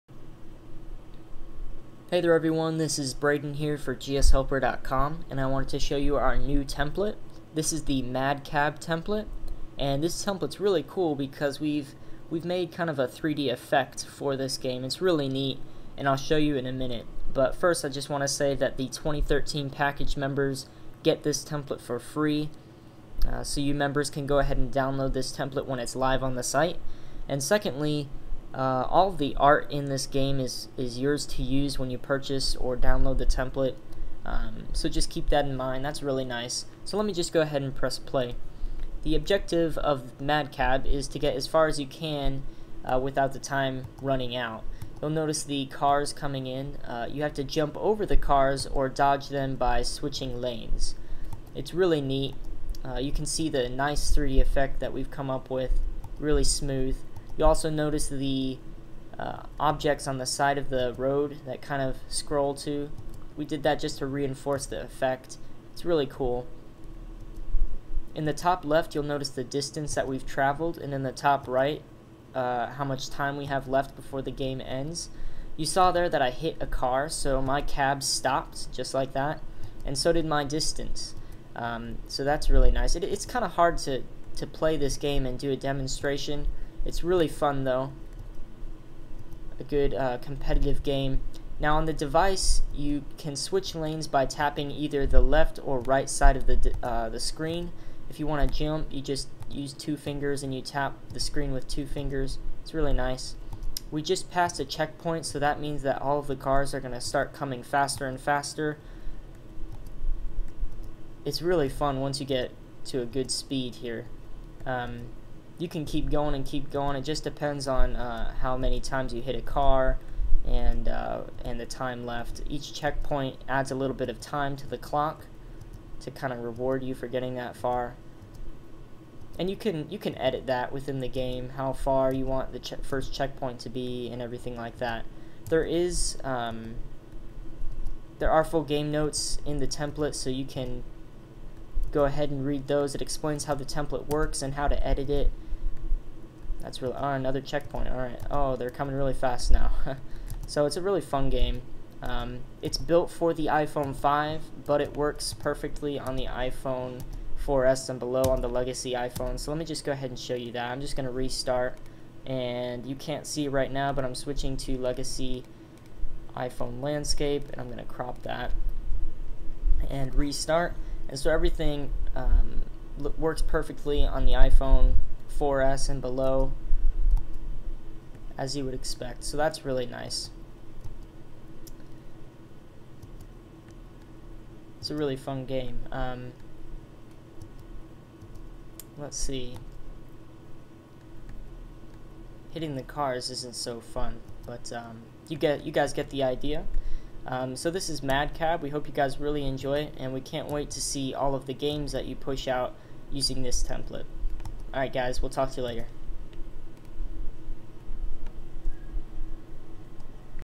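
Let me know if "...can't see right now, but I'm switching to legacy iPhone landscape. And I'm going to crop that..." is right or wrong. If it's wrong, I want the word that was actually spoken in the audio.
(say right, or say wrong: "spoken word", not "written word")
right.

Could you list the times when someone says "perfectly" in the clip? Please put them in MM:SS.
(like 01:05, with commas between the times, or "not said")
02:35, 02:53.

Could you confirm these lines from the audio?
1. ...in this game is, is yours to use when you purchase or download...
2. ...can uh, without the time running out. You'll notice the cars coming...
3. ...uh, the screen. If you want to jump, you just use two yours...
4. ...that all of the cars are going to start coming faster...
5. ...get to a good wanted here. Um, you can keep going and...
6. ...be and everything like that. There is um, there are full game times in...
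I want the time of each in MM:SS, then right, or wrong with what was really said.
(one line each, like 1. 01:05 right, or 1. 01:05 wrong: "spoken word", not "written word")
1. 00:29 right
2. 00:41 right
3. 01:36 wrong: "fingers", not "yours"
4. 01:45 right
5. 01:52 wrong: "speed", not "wanted"
6. 02:13 wrong: "notes", not "times".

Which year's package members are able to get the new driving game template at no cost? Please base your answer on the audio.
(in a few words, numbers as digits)
2013.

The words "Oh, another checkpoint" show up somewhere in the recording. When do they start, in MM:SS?
02:26.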